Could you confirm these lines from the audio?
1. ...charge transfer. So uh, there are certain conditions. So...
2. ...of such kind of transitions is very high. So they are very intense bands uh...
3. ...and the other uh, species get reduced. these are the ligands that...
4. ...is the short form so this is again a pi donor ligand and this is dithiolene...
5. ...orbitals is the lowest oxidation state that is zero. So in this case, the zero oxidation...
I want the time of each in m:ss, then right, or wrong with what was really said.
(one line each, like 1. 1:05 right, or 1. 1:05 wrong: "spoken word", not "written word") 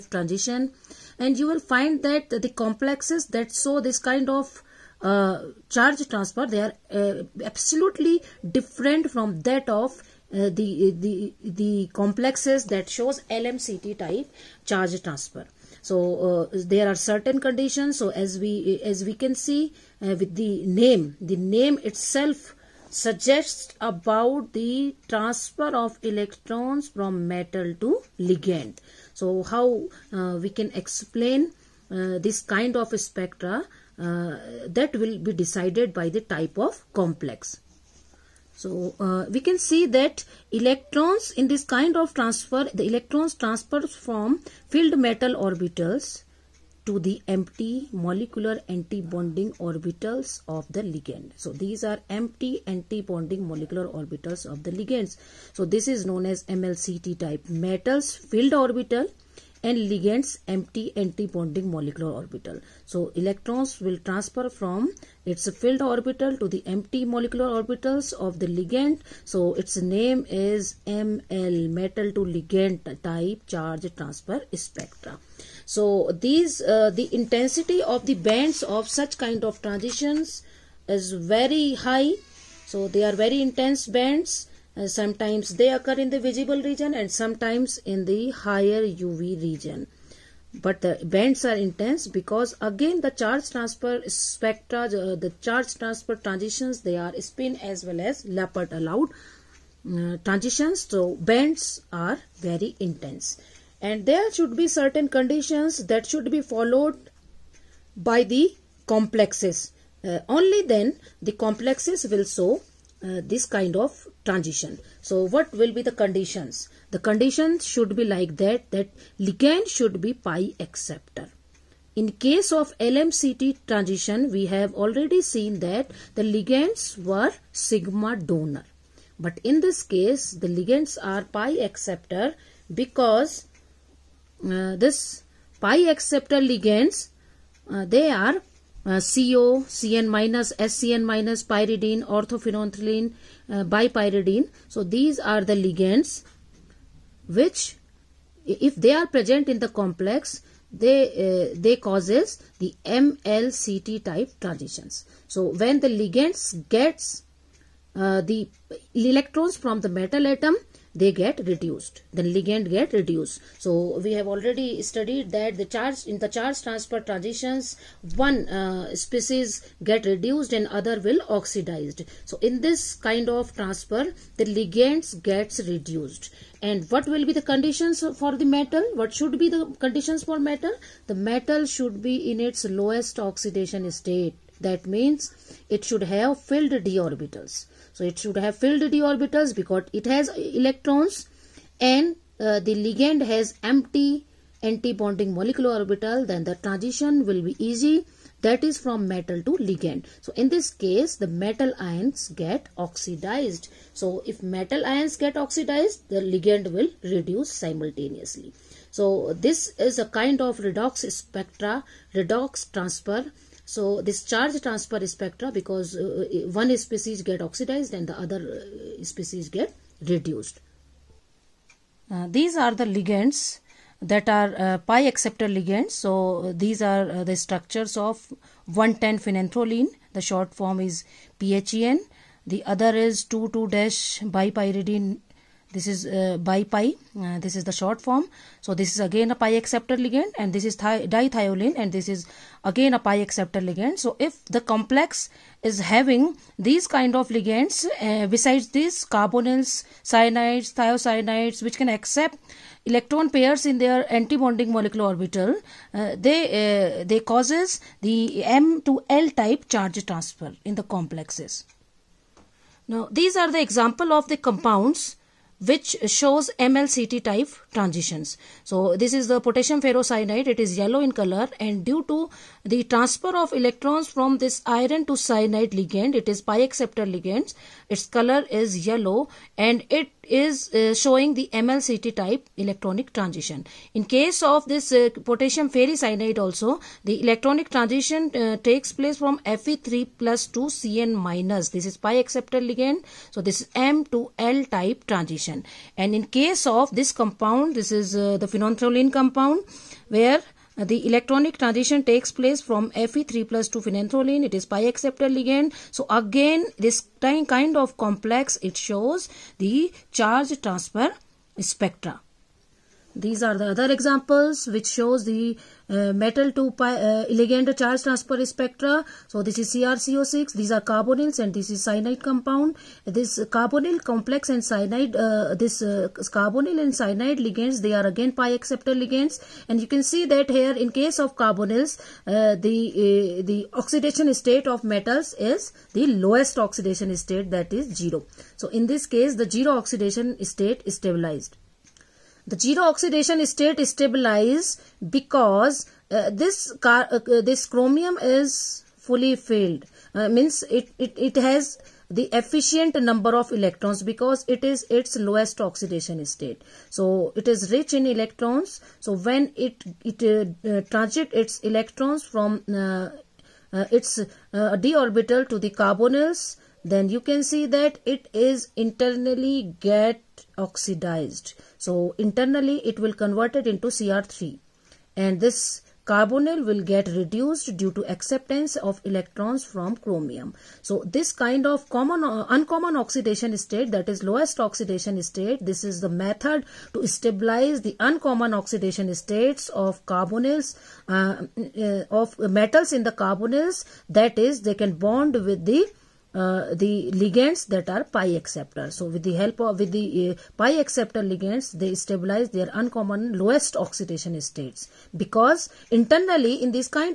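1. 0:14 right
2. 1:18 right
3. 3:37 right
4. 3:57 wrong: "acceptor", not "donor"
5. 5:34 wrong: "metals", not "orbitals".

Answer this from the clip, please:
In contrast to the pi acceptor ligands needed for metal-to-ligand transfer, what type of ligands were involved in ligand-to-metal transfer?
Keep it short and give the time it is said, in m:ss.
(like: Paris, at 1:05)
Sigma donor, at 2:07.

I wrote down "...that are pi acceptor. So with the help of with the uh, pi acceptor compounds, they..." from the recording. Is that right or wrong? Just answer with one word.
wrong.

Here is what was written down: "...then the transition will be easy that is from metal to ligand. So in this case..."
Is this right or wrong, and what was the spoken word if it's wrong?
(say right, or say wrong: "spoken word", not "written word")
right.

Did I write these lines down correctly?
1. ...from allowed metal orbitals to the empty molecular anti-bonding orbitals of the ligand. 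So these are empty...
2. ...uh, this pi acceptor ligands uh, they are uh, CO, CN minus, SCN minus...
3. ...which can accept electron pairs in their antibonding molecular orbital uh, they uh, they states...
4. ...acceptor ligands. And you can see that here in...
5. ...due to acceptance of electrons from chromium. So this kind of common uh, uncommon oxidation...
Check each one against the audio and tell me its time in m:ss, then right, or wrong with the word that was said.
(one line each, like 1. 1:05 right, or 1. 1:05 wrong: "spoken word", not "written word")
1. 0:43 wrong: "filled", not "allowed"
2. 2:14 right
3. 4:11 wrong: "causes", not "states"
4. 5:28 right
5. 6:17 right.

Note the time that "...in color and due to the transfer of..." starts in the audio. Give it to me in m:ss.
4:31.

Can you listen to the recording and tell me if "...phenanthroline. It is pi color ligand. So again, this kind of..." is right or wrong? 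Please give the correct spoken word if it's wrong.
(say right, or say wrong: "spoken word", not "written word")
wrong: "acceptor", not "color".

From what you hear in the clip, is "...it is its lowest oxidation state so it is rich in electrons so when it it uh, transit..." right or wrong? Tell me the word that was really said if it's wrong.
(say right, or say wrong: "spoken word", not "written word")
right.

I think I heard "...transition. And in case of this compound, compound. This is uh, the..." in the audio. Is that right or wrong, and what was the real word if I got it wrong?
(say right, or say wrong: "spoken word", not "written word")
right.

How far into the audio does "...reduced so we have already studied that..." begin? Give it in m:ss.
2:42.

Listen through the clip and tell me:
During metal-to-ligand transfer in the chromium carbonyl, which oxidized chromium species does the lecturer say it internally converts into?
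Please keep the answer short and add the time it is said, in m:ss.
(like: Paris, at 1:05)
Cr3, at 6:13.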